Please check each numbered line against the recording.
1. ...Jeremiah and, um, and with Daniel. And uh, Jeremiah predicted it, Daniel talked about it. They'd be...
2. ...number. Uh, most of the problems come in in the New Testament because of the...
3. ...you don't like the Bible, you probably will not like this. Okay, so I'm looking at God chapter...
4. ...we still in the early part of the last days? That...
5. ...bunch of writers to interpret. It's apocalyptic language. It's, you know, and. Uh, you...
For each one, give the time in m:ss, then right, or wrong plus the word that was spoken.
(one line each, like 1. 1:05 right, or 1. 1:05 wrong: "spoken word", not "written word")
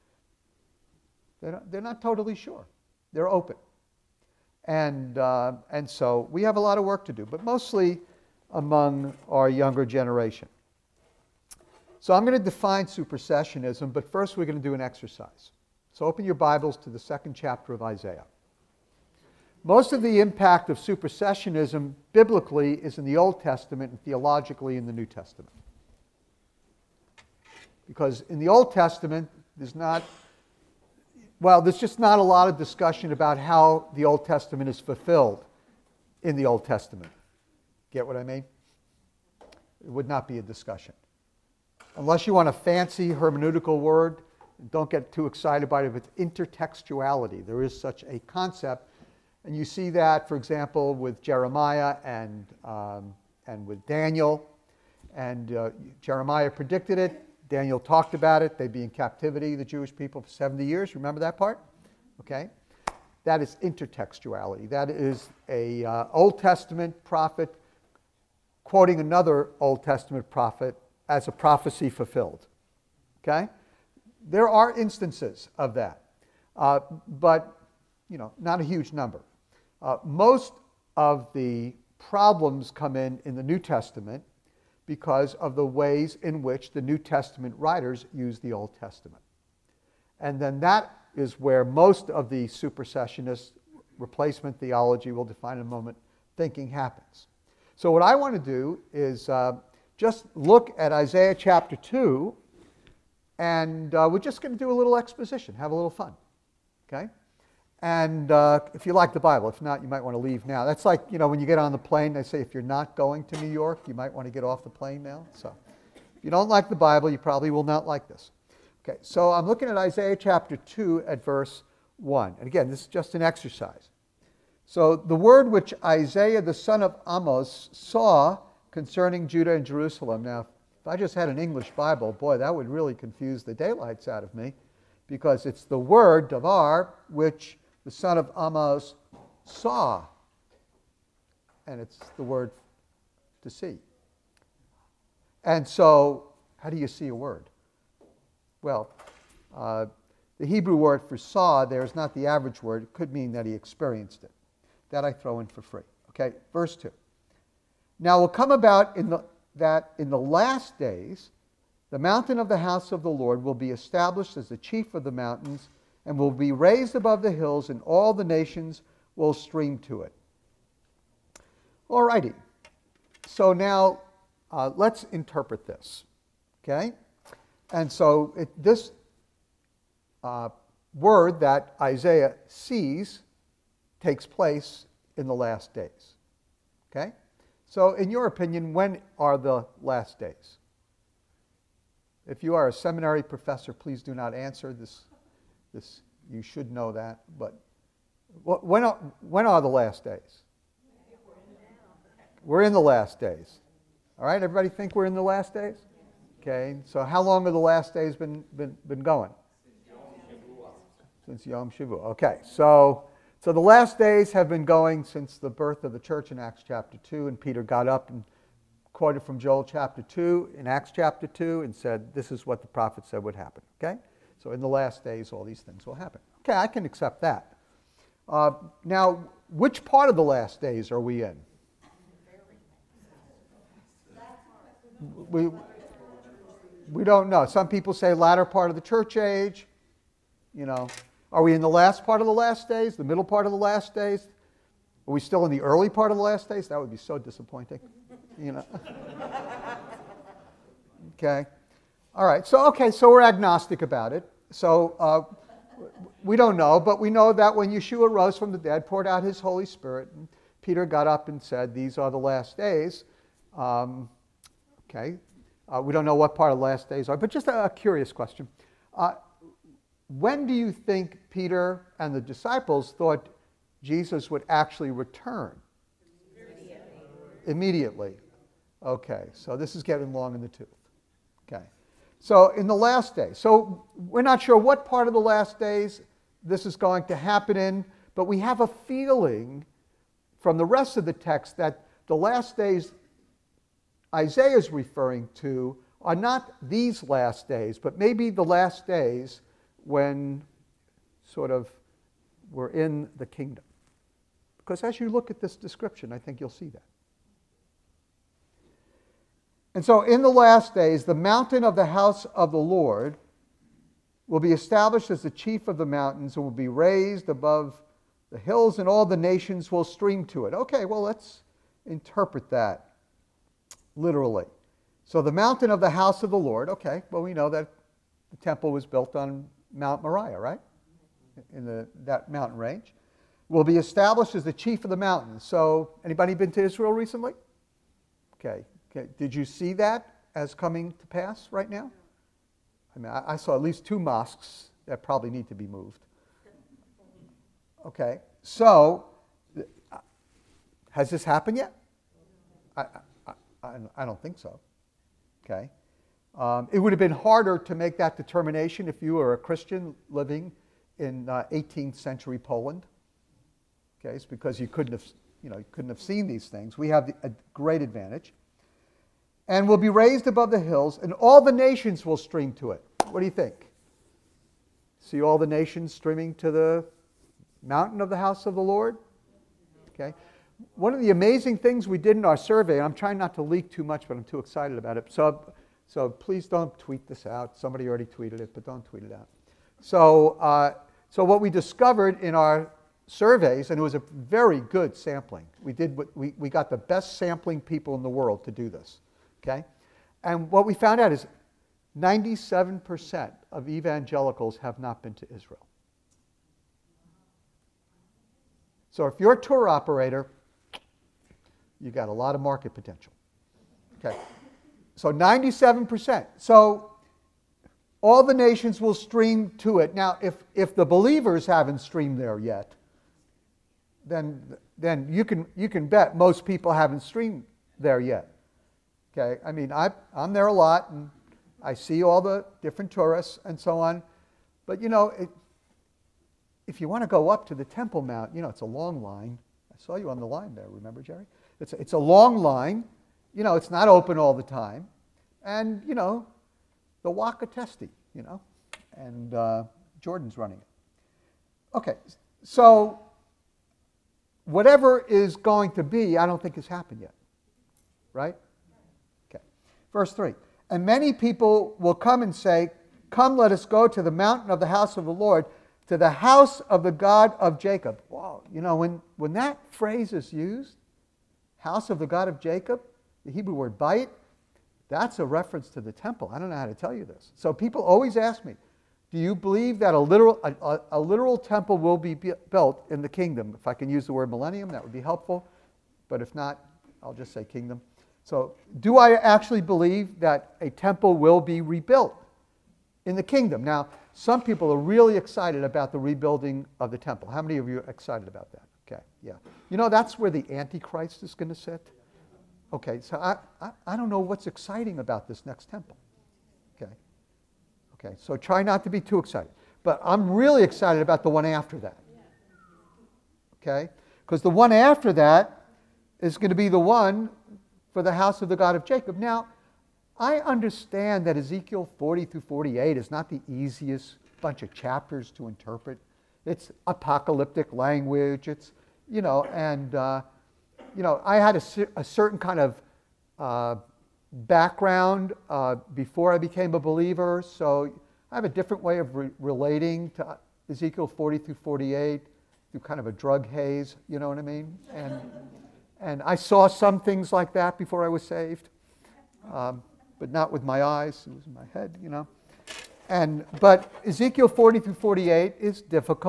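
1. 0:51 right
2. 1:18 right
3. 1:56 wrong: "Isaiah", not "God"
4. 4:05 right
5. 8:44 wrong: "chapters", not "writers".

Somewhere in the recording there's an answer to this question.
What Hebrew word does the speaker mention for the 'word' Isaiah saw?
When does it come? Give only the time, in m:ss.
2:16.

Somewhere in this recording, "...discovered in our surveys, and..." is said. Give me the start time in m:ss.
6:31.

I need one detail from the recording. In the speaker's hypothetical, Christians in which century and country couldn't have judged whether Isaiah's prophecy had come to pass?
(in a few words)
18th century Poland.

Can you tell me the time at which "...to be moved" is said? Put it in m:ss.
5:45.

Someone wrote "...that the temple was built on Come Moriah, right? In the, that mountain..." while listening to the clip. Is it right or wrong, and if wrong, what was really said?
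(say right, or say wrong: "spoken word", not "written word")
wrong: "Mount", not "Come".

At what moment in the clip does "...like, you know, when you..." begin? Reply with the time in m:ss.
1:50.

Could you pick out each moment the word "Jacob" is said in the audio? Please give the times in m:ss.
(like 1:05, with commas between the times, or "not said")
7:47, 7:52, 8:38.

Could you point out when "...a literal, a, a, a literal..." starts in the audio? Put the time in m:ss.
7:59.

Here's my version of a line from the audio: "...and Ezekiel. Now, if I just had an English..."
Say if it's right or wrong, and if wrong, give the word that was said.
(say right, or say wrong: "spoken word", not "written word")
wrong: "Jerusalem", not "Ezekiel".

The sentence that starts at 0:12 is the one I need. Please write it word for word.
So I'm going to define supersessionism, but first we're going to do an exercise.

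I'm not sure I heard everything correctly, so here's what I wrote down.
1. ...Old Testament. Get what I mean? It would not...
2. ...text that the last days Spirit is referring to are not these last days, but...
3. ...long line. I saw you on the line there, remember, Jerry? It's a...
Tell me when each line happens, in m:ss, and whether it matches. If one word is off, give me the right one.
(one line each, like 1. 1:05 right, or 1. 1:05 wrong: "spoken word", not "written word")
1. 0:36 right
2. 4:51 wrong: "Isaiah", not "Spirit"
3. 7:18 right.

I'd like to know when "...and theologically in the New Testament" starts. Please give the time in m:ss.
0:23.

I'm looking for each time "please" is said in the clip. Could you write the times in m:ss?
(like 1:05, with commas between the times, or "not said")
3:13, 6:26.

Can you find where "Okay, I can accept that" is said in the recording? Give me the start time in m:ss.
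3:46.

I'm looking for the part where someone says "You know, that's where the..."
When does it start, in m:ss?
8:19.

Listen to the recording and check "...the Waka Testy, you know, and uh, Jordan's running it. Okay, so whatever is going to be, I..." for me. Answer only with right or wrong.
right.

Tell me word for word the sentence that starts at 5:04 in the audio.
Because as you look at this description, I think you'll see that.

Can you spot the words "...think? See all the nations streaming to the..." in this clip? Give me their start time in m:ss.
6:13.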